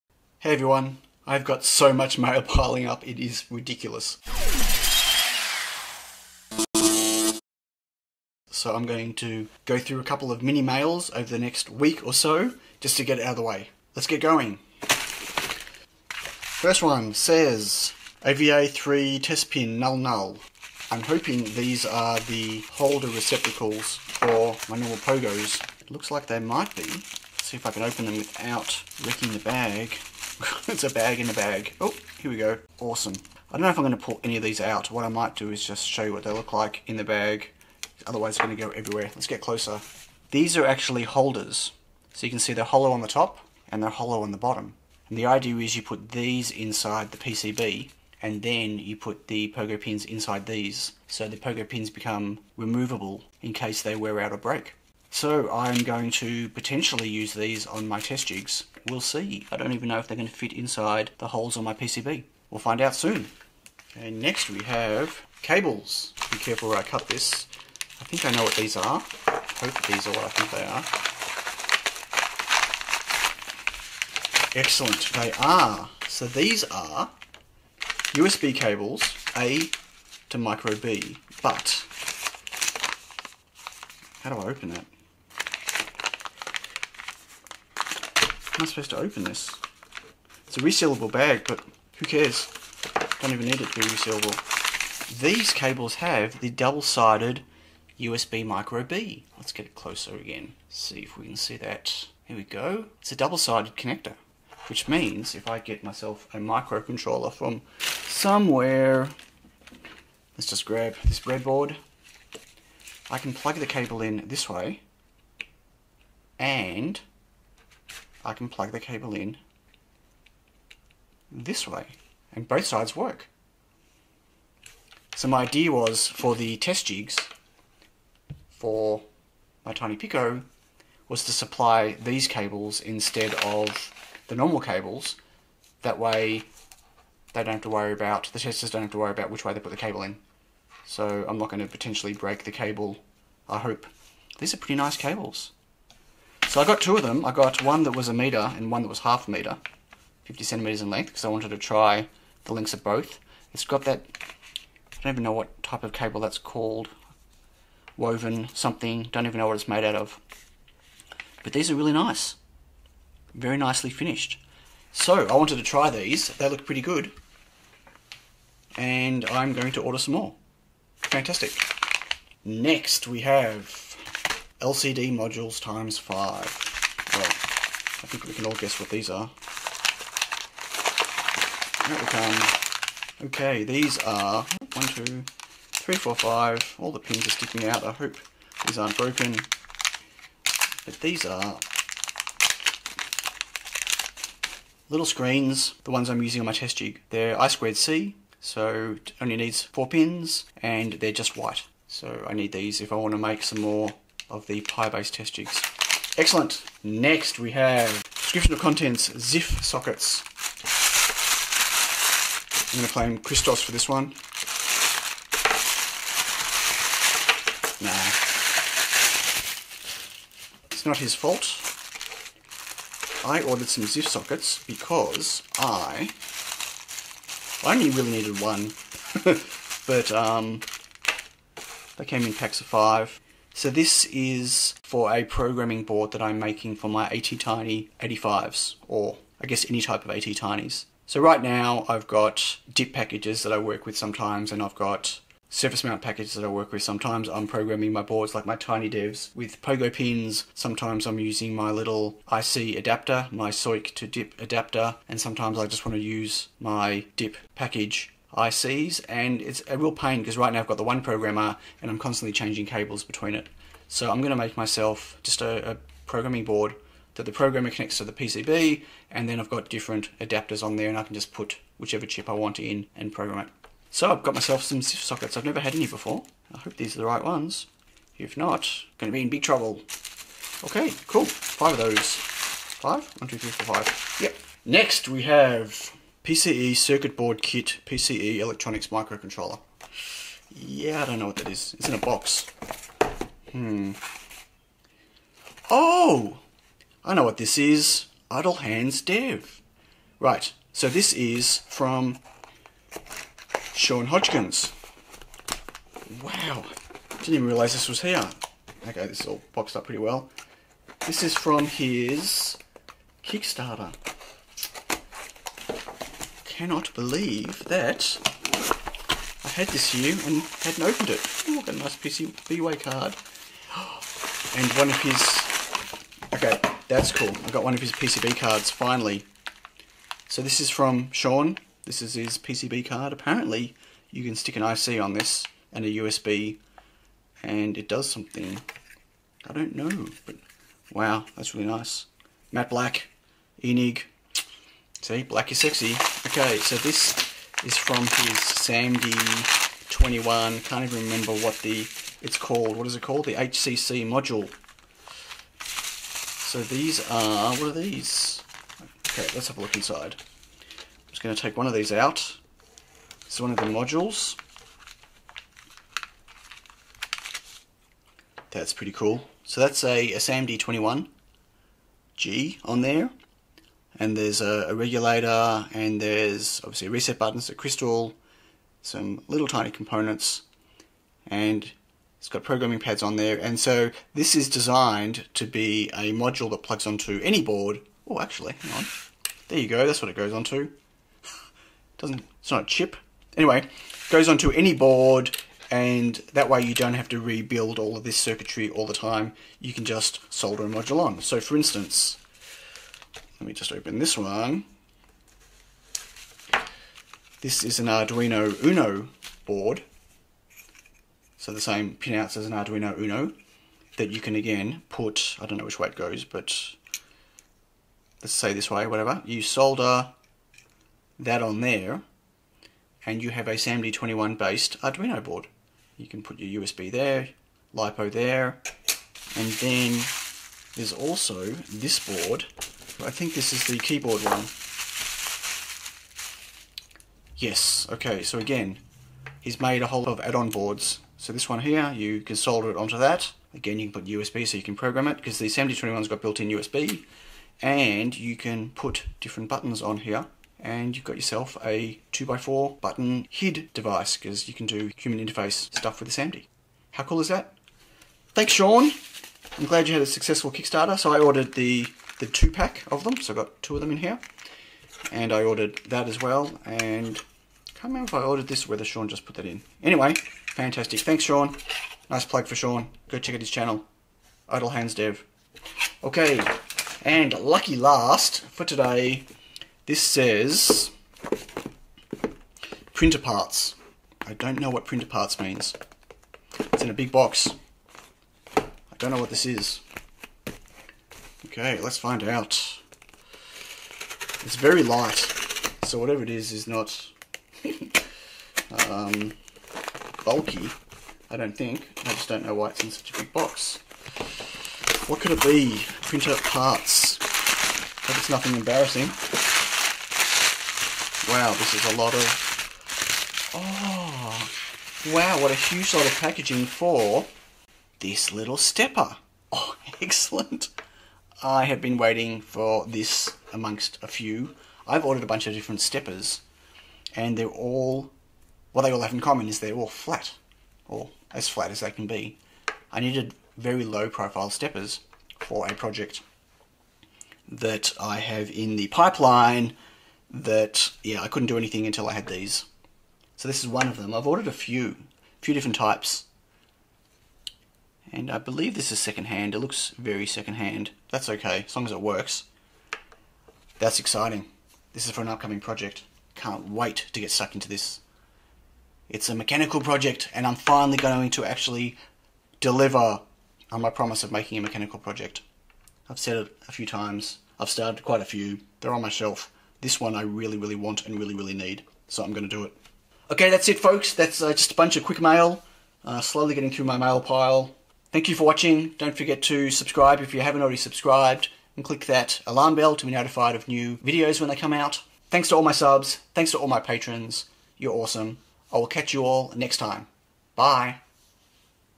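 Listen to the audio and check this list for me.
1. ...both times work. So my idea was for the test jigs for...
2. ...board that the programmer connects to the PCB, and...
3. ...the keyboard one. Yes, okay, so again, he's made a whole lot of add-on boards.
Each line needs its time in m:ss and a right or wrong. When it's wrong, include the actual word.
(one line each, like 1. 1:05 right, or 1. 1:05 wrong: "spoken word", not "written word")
1. 2:02 wrong: "sides", not "times"
2. 4:26 right
3. 7:13 right.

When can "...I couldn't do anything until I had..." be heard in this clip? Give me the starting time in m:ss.
9:01.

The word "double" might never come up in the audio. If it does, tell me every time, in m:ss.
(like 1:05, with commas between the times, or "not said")
1:36, 1:43.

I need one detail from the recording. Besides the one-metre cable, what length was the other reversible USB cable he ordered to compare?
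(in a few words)
50 centimetres.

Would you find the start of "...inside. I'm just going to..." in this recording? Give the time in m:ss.
5:59.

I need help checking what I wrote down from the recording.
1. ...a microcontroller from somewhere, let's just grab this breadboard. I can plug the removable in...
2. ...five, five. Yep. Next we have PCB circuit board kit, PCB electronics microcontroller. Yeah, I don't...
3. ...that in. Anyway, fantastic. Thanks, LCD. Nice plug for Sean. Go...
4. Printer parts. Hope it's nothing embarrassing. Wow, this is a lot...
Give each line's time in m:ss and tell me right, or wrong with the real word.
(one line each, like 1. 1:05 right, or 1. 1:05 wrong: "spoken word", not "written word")
1. 1:46 wrong: "cable", not "removable"
2. 4:43 wrong: "four", not "five"
3. 7:49 wrong: "Sean", not "LCD"
4. 8:26 right.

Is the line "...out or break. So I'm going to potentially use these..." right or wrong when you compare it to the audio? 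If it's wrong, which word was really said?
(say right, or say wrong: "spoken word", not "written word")
right.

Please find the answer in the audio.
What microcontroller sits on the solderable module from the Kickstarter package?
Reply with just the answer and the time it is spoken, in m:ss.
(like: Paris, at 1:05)
SAMD21G, at 6:10.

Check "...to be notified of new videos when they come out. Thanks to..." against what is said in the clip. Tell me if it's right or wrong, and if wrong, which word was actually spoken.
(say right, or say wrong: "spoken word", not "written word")
right.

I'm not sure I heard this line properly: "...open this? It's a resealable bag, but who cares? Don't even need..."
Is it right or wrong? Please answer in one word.
right.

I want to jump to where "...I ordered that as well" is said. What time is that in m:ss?
7:45.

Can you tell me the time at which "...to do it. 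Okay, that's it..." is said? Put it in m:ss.
9:32.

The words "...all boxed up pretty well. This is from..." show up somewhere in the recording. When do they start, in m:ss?
5:09.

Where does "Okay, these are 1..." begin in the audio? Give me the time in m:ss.
3:03.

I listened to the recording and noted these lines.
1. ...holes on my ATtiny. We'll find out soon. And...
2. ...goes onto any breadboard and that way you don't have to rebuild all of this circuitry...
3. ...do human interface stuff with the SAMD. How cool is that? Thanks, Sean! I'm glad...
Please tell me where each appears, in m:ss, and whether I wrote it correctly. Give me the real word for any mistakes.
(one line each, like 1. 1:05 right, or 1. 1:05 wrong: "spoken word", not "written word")
1. 1:01 wrong: "PCB", not "ATtiny"
2. 6:34 wrong: "board", not "breadboard"
3. 7:34 right.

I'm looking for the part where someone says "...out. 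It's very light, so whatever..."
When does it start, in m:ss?
8:12.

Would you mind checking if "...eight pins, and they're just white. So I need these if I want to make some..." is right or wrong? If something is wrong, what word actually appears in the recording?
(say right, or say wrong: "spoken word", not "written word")
wrong: "four", not "eight".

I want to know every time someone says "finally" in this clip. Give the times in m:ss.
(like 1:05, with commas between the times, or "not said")
5:28, 9:20.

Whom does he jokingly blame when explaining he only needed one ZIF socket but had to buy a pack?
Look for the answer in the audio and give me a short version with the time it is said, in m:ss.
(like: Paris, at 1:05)
Christos, at 3:33.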